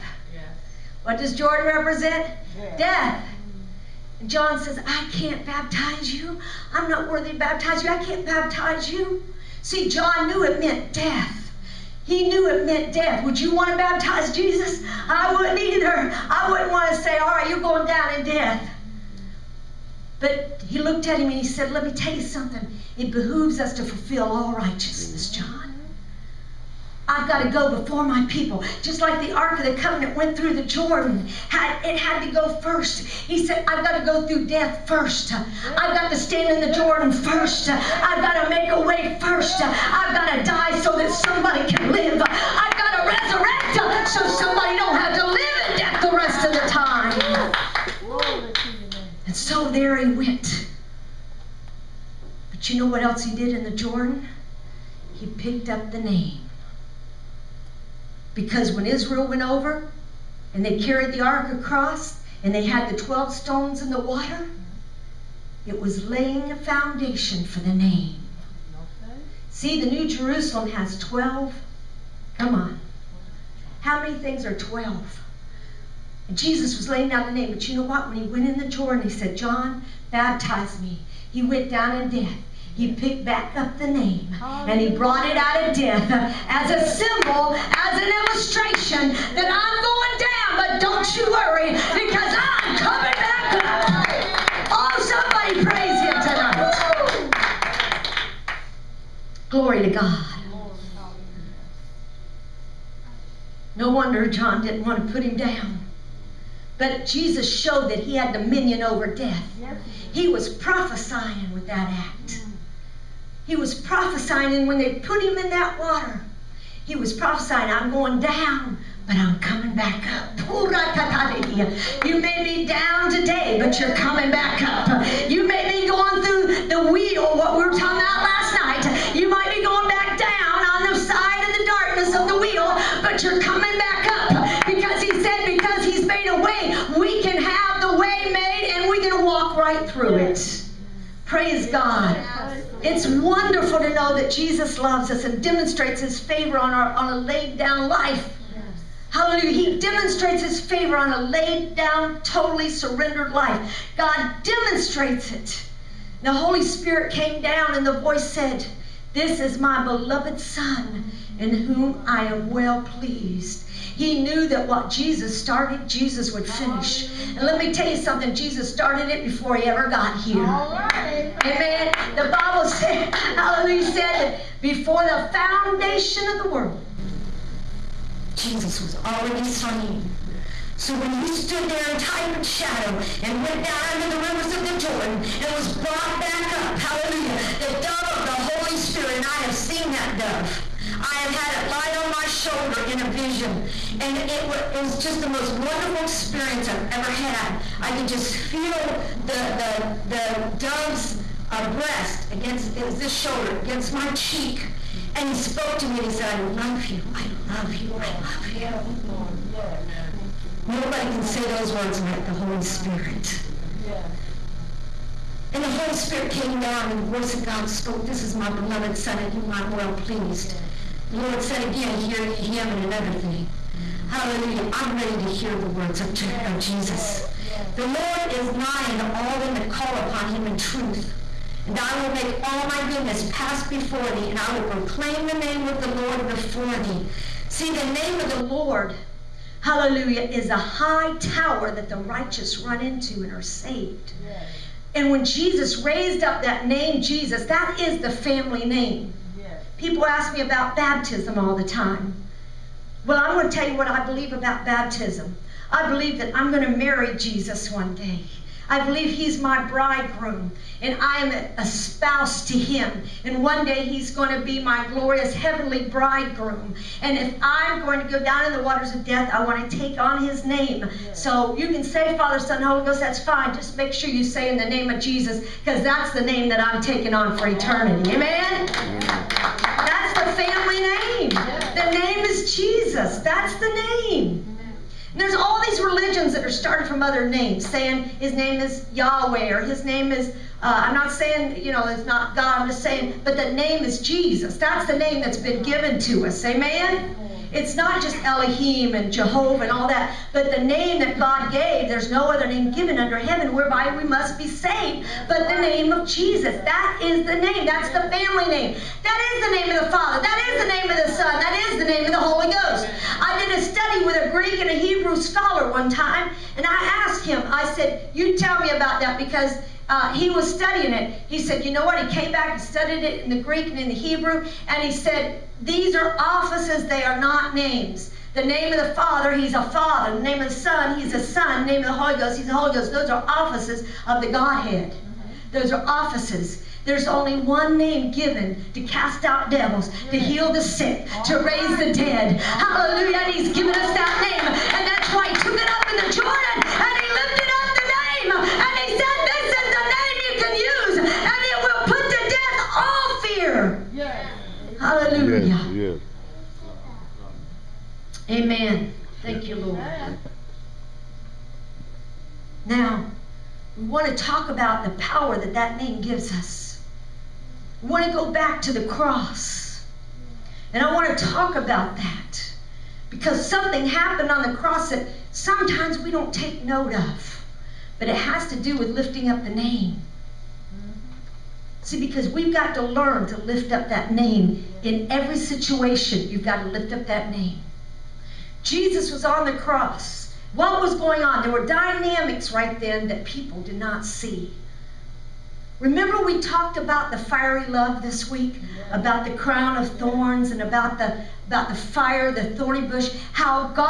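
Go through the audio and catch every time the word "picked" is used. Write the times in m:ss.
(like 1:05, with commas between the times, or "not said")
0:55, 1:22.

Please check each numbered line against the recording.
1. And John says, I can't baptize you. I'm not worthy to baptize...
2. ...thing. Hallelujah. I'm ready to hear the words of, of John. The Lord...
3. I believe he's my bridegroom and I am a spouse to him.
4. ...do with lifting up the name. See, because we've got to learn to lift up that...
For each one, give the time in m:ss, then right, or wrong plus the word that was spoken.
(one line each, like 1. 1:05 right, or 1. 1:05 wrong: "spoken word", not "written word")
1. 0:04 right
2. 3:43 wrong: "Jesus", not "John"
3. 4:18 right
4. 6:18 right.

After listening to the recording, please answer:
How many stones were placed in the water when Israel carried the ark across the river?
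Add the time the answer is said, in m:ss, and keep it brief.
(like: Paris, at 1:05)
12, at 1:03.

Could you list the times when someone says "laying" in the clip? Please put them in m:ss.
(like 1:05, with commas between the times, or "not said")
1:06, 1:16.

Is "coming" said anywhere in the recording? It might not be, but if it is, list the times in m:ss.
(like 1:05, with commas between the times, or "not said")
1:32, 1:59, 2:03, 2:13.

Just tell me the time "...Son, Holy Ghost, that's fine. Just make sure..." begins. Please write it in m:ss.
4:32.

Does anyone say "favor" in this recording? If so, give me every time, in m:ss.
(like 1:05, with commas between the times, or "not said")
2:26, 2:30.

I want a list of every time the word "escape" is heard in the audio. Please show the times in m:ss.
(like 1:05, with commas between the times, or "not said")
not said.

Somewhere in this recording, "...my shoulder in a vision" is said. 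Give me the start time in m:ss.
3:12.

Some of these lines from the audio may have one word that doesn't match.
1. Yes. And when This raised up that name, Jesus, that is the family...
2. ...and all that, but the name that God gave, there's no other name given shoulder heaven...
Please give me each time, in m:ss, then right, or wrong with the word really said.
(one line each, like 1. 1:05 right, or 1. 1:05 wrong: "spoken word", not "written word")
1. 4:04 wrong: "Jesus", not "This"
2. 4:59 wrong: "under", not "shoulder".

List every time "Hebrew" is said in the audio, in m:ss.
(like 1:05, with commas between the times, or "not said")
5:14, 5:23.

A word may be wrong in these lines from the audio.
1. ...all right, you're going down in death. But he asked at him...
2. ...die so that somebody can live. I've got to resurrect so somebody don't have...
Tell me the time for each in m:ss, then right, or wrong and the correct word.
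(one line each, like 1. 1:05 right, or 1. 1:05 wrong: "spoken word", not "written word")
1. 0:17 wrong: "looked", not "asked"
2. 0:40 right.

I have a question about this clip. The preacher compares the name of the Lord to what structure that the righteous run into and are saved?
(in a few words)
A high tower.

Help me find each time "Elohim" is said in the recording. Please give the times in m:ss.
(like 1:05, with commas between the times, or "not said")
4:58.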